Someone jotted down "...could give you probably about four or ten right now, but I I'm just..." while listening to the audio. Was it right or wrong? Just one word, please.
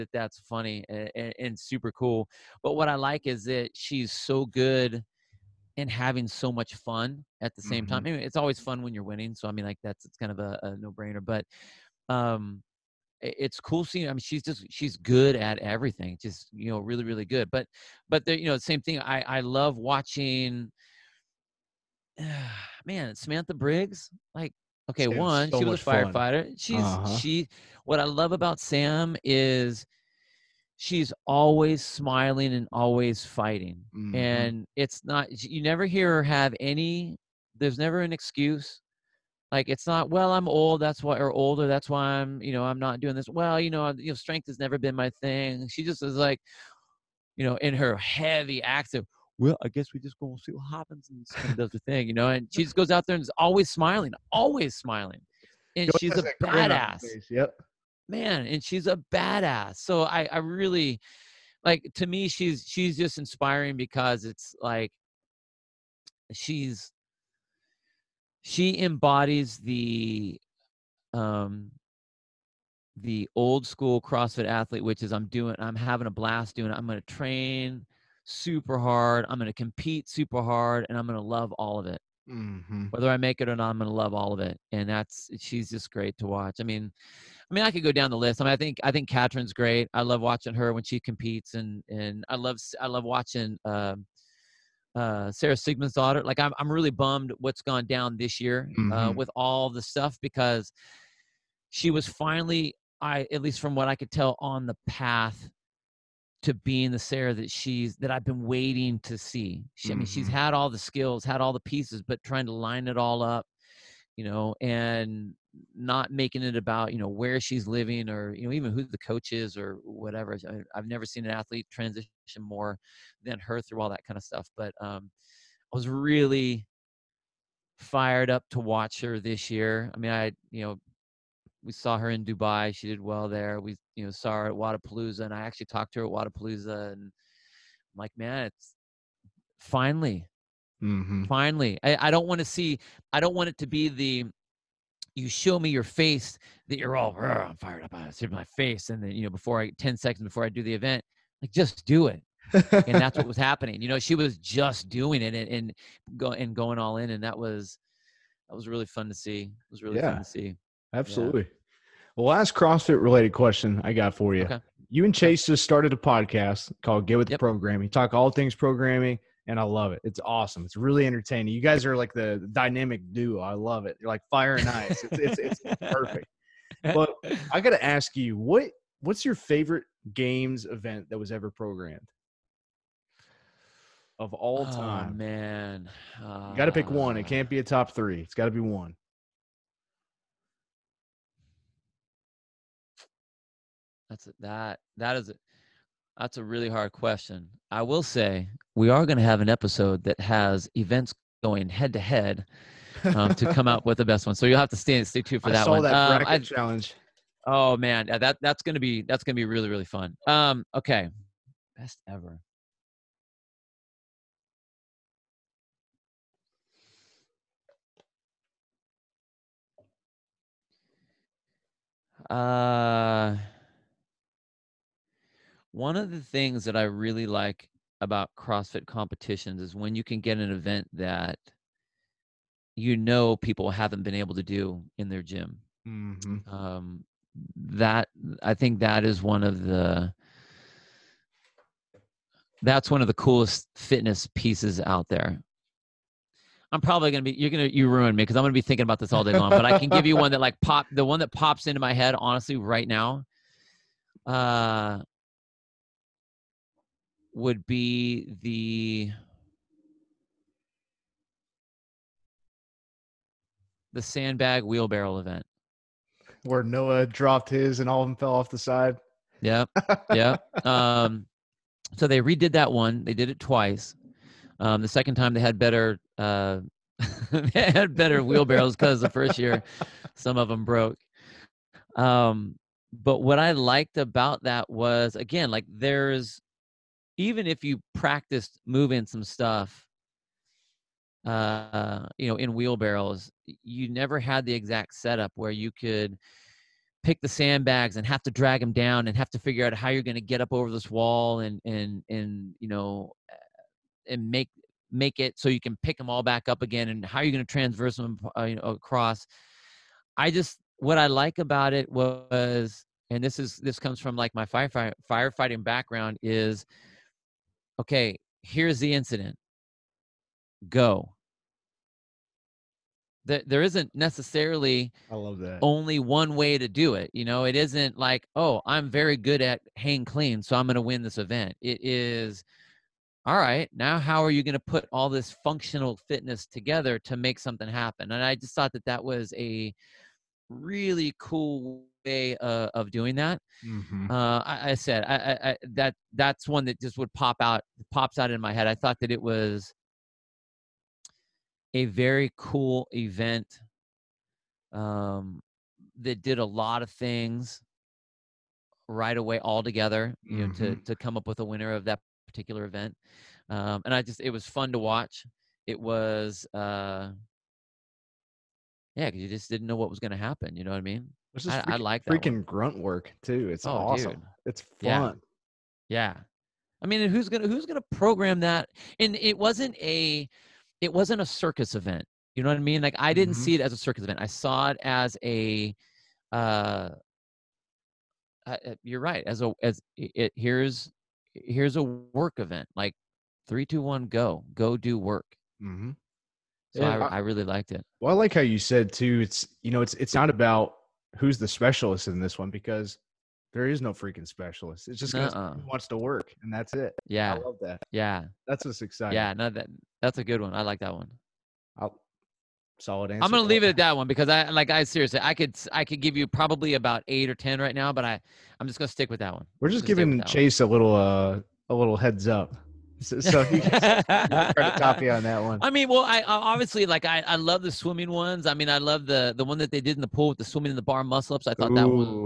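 wrong.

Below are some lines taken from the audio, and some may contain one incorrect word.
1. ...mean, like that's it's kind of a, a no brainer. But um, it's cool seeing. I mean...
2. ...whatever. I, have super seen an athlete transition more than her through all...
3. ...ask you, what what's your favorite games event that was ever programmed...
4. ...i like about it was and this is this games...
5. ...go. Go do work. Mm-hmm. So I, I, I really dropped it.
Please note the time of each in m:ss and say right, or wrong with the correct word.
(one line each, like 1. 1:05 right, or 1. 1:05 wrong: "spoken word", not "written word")
1. 0:09 right
2. 1:59 wrong: "never", not "super"
3. 2:57 right
4. 5:10 wrong: "comes", not "games"
5. 6:34 wrong: "liked", not "dropped".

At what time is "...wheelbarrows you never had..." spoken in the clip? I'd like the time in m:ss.
4:52.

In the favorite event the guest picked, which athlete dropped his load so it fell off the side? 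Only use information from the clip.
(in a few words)
Noah.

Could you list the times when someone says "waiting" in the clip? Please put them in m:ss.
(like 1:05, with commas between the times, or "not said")
1:48.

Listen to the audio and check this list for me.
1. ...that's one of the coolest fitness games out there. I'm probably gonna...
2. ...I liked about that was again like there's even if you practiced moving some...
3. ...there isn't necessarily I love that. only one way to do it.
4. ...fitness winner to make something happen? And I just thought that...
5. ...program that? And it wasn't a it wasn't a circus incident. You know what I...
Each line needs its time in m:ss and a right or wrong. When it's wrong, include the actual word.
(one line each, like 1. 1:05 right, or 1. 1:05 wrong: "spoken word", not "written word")
1. 4:02 wrong: "pieces", not "games"
2. 4:43 right
3. 5:23 right
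4. 5:36 wrong: "together", not "winner"
5. 6:17 wrong: "event", not "incident".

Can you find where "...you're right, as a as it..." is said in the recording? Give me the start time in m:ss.
6:28.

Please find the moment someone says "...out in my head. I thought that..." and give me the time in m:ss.
5:48.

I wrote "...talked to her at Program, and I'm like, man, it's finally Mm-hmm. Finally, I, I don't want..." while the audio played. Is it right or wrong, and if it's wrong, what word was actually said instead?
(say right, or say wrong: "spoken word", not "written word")
wrong: "Wodapalooza", not "Program".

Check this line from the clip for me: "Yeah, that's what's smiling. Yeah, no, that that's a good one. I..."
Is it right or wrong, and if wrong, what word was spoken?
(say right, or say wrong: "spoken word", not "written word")
wrong: "exciting", not "smiling".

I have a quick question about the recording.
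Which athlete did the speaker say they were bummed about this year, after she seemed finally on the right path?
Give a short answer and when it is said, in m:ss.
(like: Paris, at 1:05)
Sara Sigmundsdottir, at 1:35.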